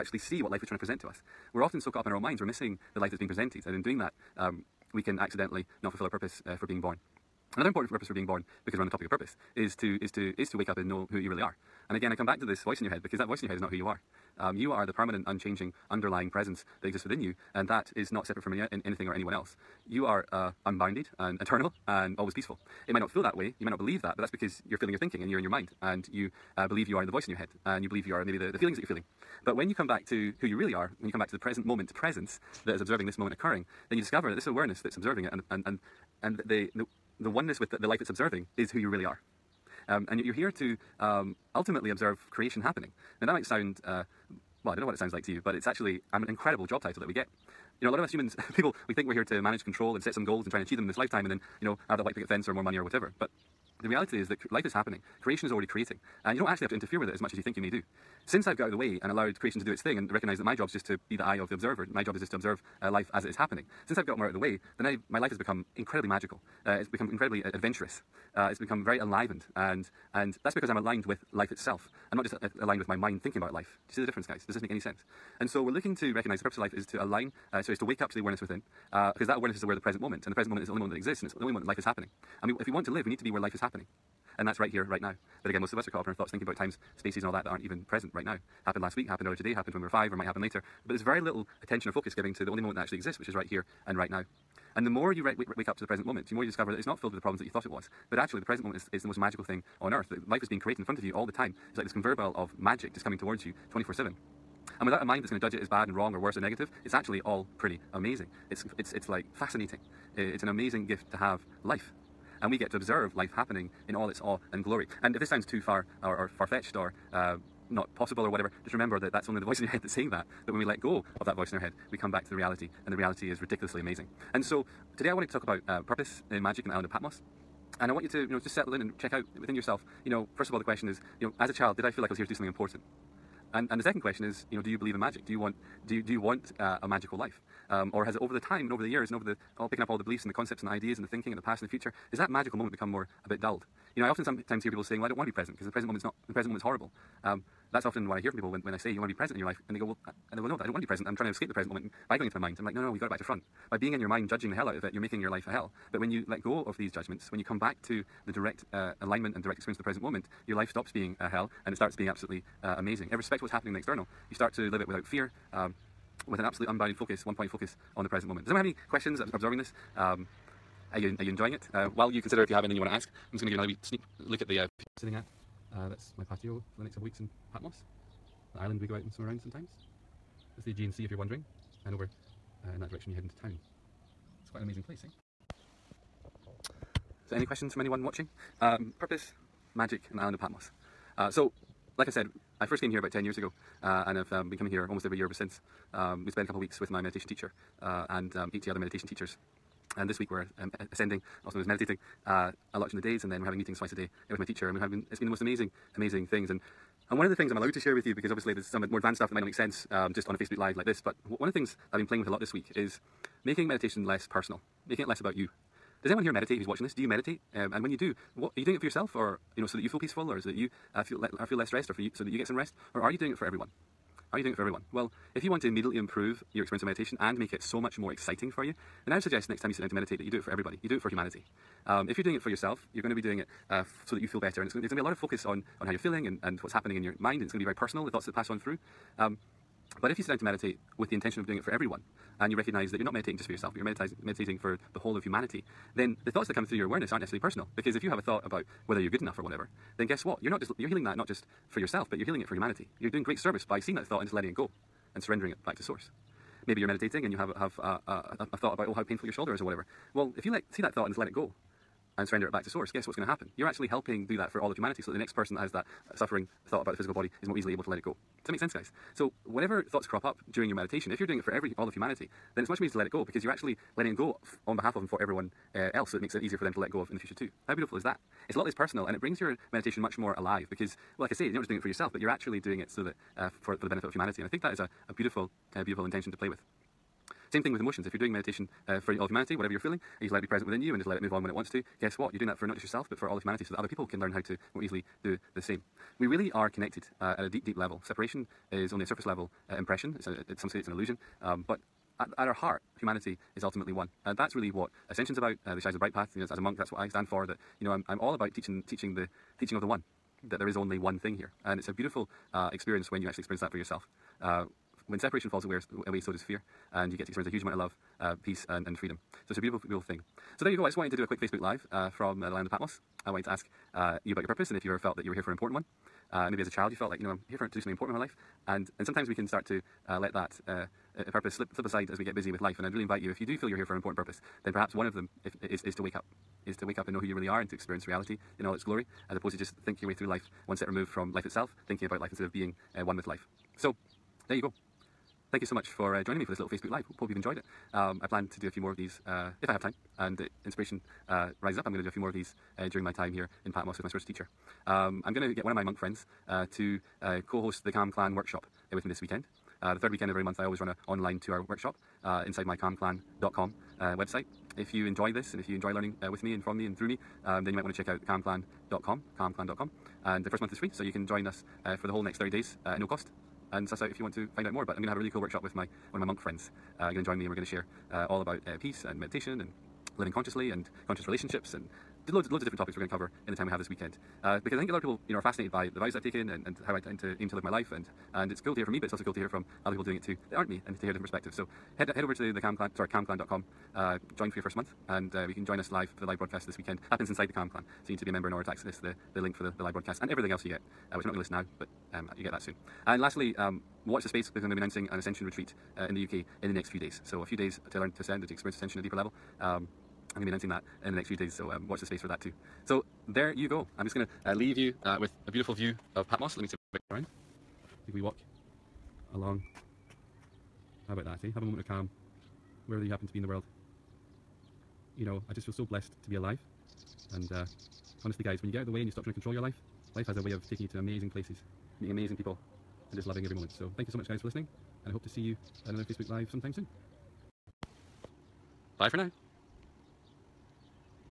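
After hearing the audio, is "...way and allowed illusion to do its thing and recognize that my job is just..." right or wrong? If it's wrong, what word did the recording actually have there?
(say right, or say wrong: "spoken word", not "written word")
wrong: "creation", not "illusion".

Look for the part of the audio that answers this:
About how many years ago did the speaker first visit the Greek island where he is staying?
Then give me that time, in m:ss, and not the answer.
3:13.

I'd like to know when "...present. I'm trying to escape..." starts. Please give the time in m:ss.
2:30.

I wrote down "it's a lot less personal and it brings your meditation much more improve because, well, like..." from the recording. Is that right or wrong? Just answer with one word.
wrong.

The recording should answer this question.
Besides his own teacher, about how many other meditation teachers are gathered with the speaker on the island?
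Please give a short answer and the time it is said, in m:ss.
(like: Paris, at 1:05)
80, at 3:18.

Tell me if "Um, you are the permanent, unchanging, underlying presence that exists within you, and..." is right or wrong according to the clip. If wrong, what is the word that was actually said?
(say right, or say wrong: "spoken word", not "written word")
right.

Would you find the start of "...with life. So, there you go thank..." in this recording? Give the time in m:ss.
5:43.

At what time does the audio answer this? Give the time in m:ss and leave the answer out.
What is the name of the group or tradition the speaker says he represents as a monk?
5:05.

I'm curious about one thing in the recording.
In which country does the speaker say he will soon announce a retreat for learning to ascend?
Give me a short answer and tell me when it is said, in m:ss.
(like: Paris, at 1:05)
UK, at 6:46.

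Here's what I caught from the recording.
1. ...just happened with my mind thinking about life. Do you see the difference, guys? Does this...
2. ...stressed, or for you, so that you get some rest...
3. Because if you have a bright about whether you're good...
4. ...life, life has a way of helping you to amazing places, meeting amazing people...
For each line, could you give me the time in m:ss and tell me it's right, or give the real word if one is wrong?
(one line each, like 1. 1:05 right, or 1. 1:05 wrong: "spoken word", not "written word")
1. 1:12 wrong: "aligned", not "happened"
2. 3:41 right
3. 4:07 wrong: "thought", not "bright"
4. 7:09 wrong: "taking", not "helping".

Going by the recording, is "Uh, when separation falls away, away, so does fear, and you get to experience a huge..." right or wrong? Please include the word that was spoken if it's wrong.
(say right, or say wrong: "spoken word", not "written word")
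right.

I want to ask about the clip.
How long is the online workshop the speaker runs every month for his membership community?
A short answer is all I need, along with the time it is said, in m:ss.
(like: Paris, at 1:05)
2 hours, at 6:01.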